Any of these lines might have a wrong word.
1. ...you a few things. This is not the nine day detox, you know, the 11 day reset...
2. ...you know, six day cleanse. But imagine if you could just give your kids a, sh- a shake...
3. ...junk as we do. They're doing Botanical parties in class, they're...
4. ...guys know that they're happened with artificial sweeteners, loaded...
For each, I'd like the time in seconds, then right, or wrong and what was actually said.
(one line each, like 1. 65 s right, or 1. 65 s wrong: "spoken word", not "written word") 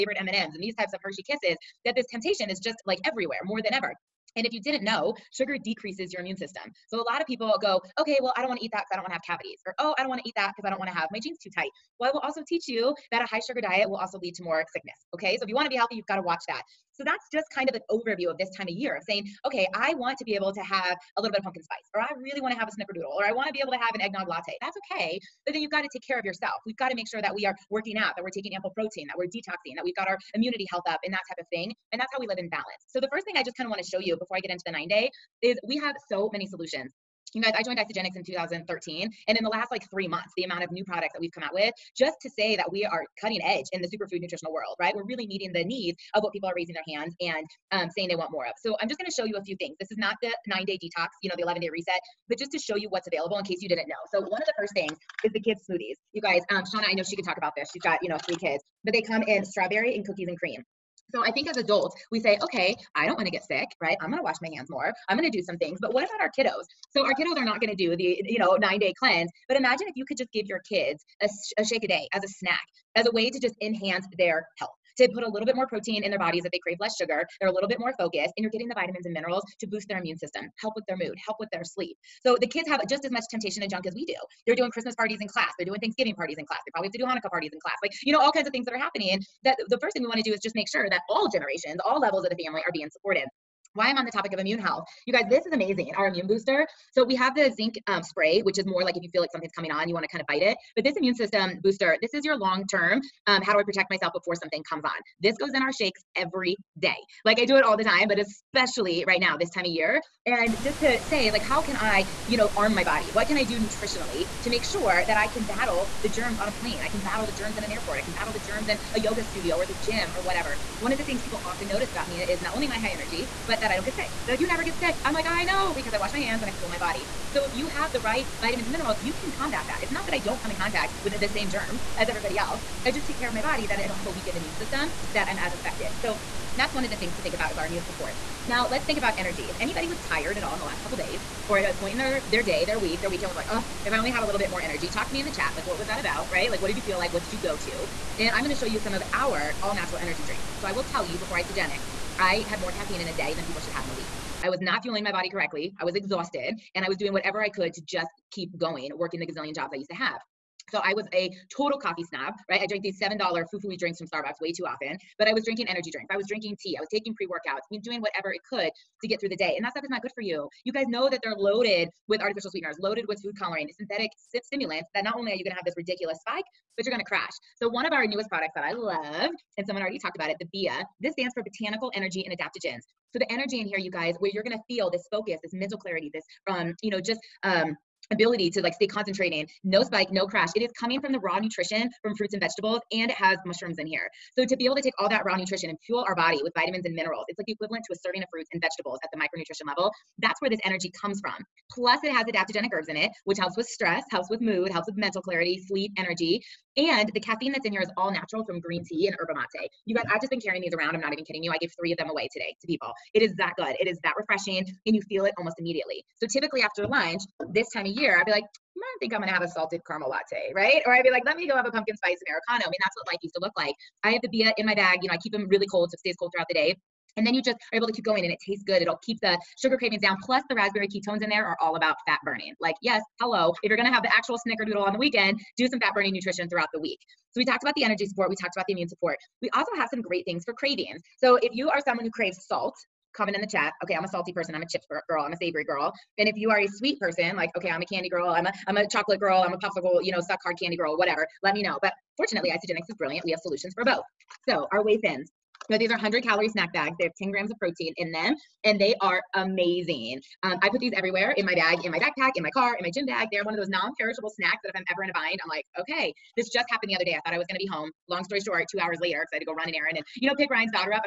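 1. 49 s right
2. 68 s wrong: "nine", not "six"
3. 83 s wrong: "Christmas", not "Botanical"
4. 170 s wrong: "loaded", not "happened".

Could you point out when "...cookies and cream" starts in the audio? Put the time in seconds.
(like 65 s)
60 s.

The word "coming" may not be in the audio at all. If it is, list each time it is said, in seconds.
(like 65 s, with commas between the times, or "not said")
99 s, 190 s.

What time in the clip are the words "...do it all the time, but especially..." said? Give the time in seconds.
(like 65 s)
107 s.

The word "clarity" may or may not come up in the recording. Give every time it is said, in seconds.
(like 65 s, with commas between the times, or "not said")
185 s, 205 s.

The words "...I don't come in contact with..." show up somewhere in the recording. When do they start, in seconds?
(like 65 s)
130 s.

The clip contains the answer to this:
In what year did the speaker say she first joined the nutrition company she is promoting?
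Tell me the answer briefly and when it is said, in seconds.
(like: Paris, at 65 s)
2013, at 38 s.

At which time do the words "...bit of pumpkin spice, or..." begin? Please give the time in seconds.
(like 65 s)
21 s.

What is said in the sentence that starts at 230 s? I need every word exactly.
Plus, the raspberry ketones in there are all about fat burning.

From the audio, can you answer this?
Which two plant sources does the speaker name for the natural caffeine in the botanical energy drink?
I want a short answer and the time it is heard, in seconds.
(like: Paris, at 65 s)
Green tea and yerba mate, at 208 s.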